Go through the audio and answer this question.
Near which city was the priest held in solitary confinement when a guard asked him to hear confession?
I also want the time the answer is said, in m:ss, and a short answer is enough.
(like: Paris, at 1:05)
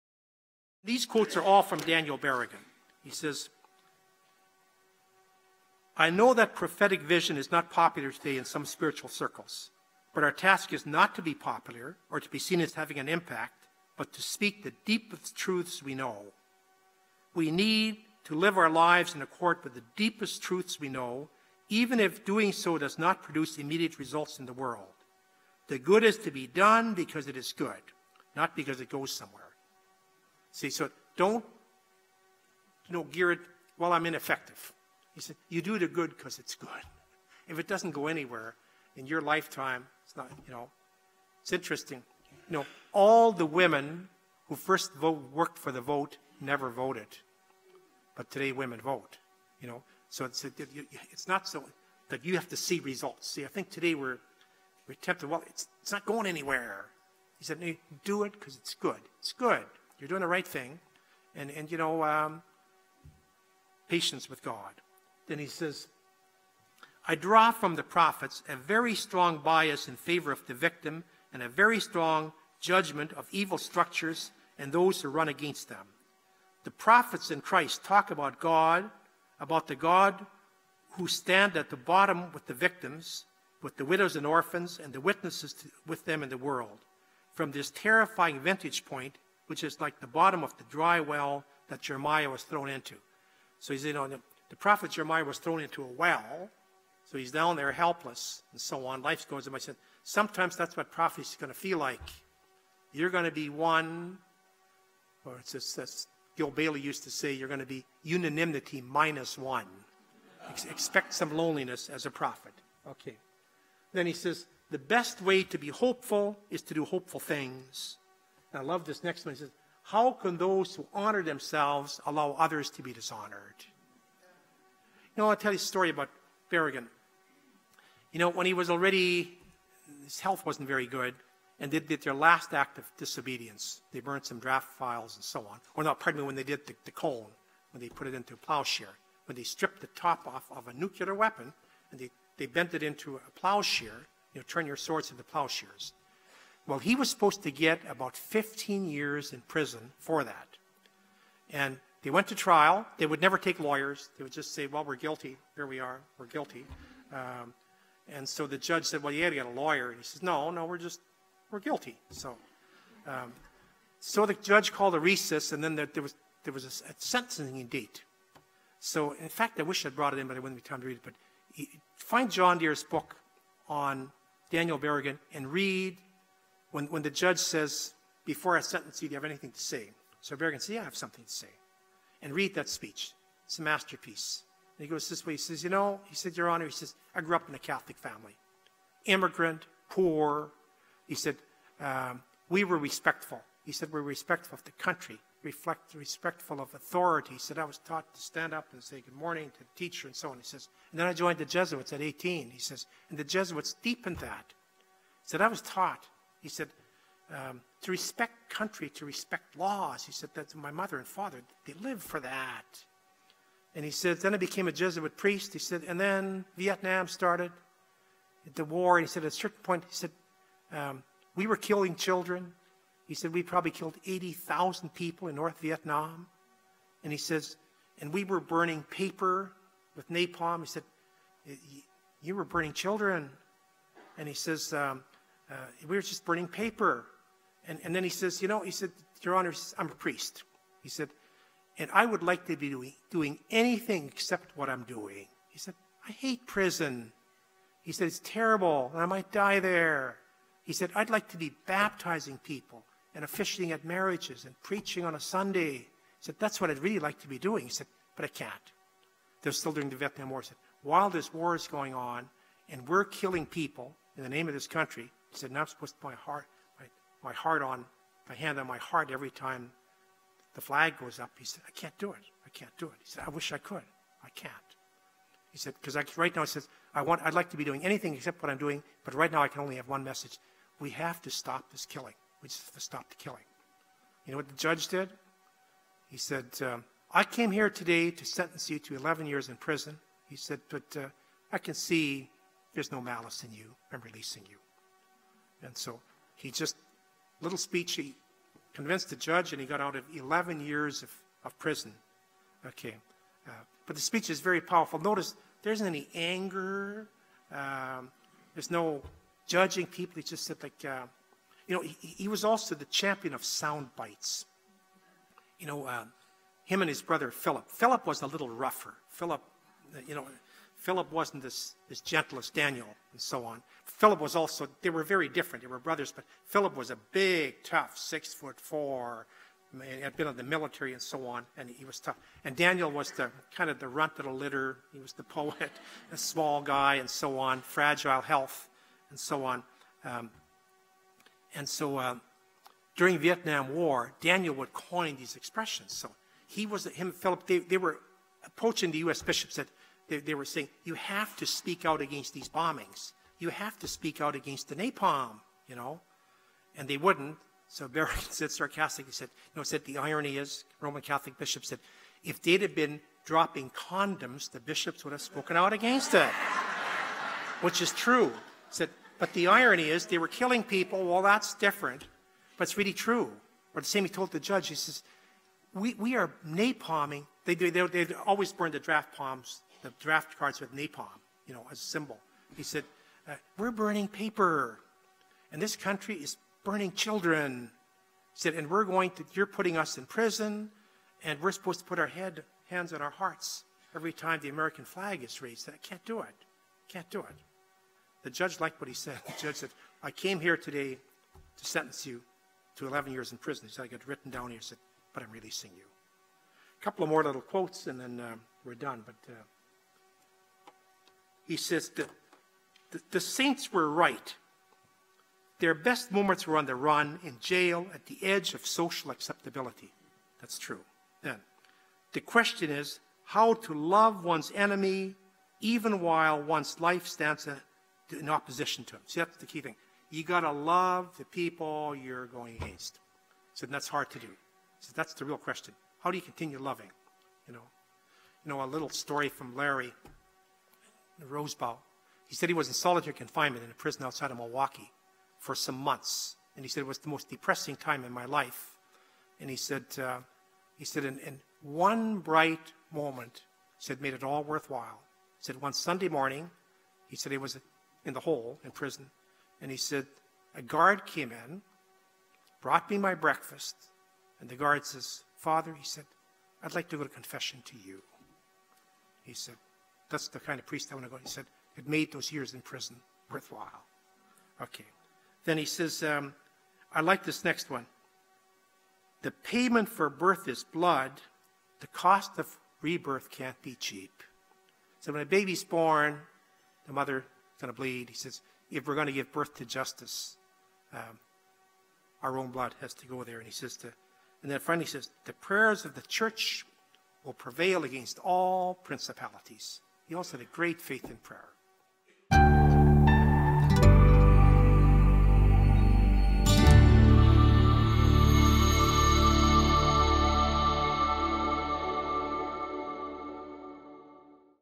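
Milwaukee, at 7:24.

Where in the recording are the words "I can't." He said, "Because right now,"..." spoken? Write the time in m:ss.
4:34.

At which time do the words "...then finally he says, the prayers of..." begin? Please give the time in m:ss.
8:14.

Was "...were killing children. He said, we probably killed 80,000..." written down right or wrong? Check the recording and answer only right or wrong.
right.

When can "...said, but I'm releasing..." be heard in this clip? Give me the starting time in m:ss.
6:44.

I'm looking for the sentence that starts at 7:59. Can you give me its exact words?
The payment for birth is blood.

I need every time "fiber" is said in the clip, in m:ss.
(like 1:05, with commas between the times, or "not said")
not said.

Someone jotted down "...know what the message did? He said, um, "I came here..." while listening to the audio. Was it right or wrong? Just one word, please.
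wrong.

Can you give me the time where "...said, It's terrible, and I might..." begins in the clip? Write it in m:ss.
4:07.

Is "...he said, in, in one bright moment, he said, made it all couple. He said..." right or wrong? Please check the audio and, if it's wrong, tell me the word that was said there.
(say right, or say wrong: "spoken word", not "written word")
wrong: "worthwhile", not "couple".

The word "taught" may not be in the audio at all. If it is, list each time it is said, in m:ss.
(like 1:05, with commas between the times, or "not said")
3:17, 3:25.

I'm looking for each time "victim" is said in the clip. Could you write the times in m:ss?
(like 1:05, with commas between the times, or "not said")
1:10, 1:22.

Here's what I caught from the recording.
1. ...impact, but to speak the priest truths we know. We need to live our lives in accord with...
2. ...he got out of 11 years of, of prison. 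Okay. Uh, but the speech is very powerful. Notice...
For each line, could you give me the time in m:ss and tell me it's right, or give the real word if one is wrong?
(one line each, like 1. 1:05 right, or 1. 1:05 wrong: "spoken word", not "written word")
1. 0:13 wrong: "deepest", not "priest"
2. 4:59 right.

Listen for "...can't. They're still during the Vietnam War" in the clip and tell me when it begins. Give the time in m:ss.
4:18.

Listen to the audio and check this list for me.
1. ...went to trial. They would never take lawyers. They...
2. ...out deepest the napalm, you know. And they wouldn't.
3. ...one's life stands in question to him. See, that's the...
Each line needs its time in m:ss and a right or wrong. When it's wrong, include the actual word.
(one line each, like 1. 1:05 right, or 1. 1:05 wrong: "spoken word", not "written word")
1. 2:32 right
2. 5:54 wrong: "against", not "deepest"
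3. 7:06 wrong: "opposition", not "question".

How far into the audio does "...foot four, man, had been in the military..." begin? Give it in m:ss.
5:28.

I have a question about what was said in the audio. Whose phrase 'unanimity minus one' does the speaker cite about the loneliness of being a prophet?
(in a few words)
Gil Bailie.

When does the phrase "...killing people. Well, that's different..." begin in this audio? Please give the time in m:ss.
6:10.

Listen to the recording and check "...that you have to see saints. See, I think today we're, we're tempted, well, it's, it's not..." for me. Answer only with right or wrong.
wrong.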